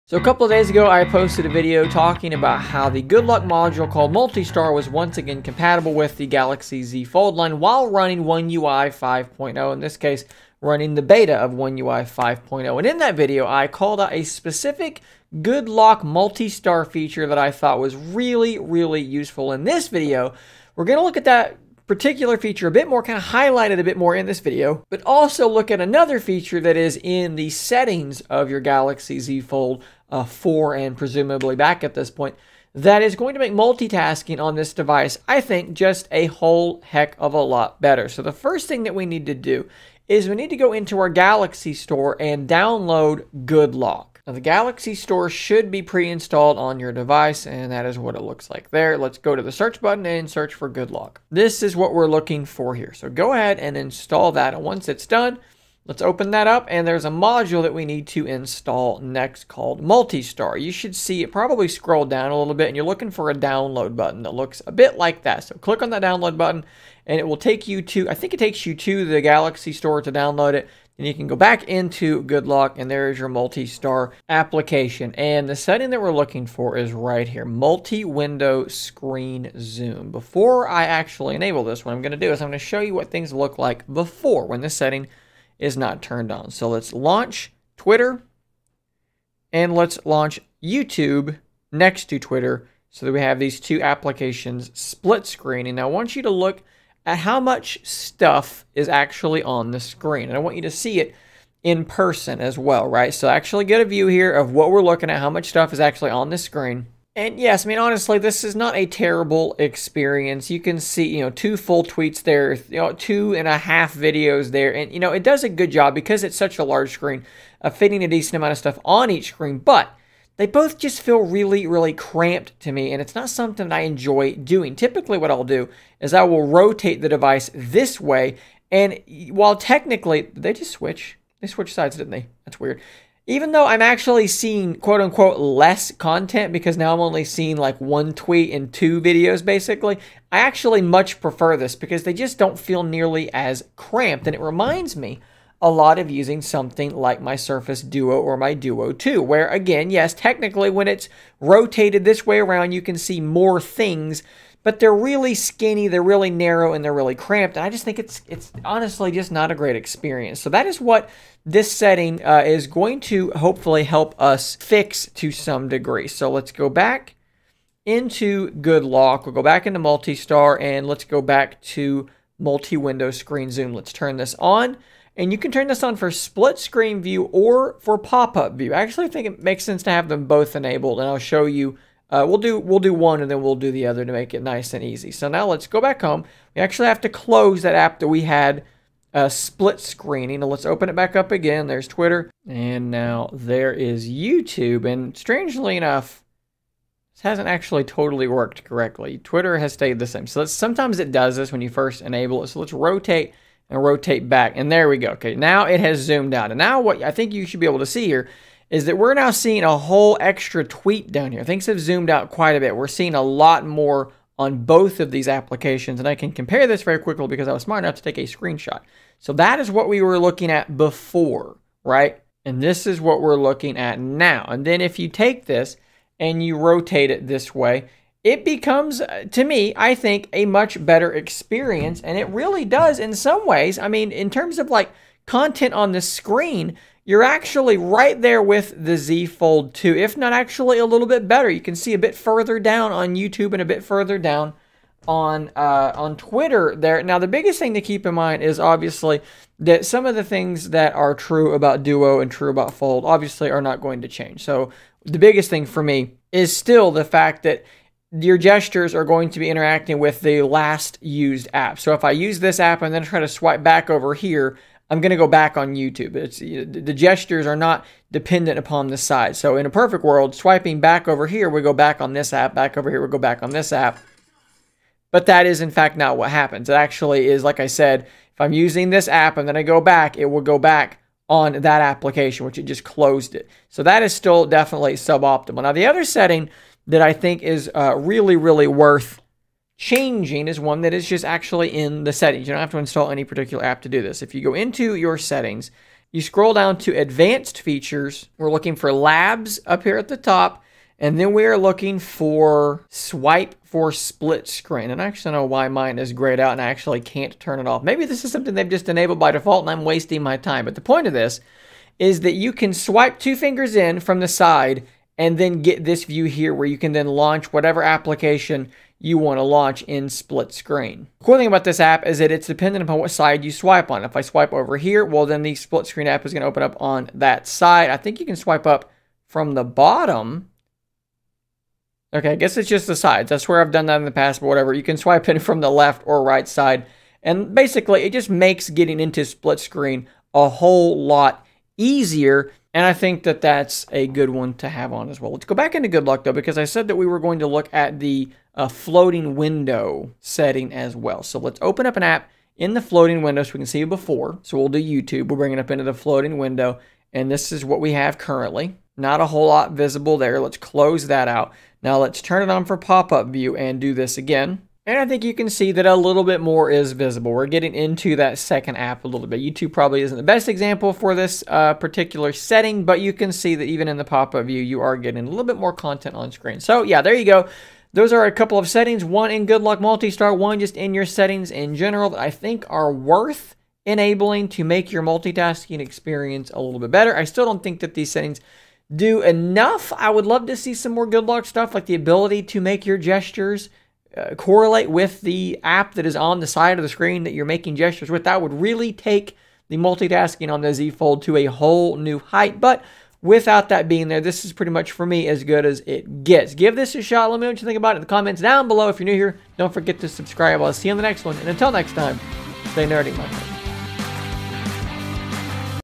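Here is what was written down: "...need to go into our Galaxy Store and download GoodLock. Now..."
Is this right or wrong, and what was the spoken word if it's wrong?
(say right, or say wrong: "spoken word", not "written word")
right.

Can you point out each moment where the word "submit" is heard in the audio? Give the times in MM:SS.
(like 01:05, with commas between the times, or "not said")
not said.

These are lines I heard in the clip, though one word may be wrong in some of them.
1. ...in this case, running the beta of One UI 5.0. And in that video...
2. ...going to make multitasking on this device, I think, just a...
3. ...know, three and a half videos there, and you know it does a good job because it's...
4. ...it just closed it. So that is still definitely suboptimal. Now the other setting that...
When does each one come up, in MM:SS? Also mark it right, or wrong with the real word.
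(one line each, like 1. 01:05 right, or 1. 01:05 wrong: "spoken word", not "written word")
1. 00:09 right
2. 00:33 right
3. 01:52 wrong: "two", not "three"
4. 04:42 right.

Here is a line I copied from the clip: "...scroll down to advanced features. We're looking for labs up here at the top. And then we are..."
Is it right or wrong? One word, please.
right.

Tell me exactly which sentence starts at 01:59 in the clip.
But they both just feel really, really cramped to me, and it's not something I enjoy doing.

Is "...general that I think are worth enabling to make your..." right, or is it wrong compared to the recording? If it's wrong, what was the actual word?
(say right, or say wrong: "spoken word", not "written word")
right.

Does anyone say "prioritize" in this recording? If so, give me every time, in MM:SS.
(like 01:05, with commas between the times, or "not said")
not said.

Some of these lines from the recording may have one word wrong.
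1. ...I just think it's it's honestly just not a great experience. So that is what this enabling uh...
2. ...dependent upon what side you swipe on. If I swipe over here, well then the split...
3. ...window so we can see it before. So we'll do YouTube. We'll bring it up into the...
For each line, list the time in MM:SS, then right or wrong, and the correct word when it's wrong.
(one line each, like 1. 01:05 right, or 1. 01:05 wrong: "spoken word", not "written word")
1. 02:37 wrong: "setting", not "enabling"
2. 05:22 right
3. 05:53 right.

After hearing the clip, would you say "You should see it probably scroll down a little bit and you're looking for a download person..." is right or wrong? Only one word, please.
wrong.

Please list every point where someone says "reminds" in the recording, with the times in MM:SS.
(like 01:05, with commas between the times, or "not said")
02:24.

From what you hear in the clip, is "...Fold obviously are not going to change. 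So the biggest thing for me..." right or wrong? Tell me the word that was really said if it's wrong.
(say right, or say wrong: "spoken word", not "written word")
right.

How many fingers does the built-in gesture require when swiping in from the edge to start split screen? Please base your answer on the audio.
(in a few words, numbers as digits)
2.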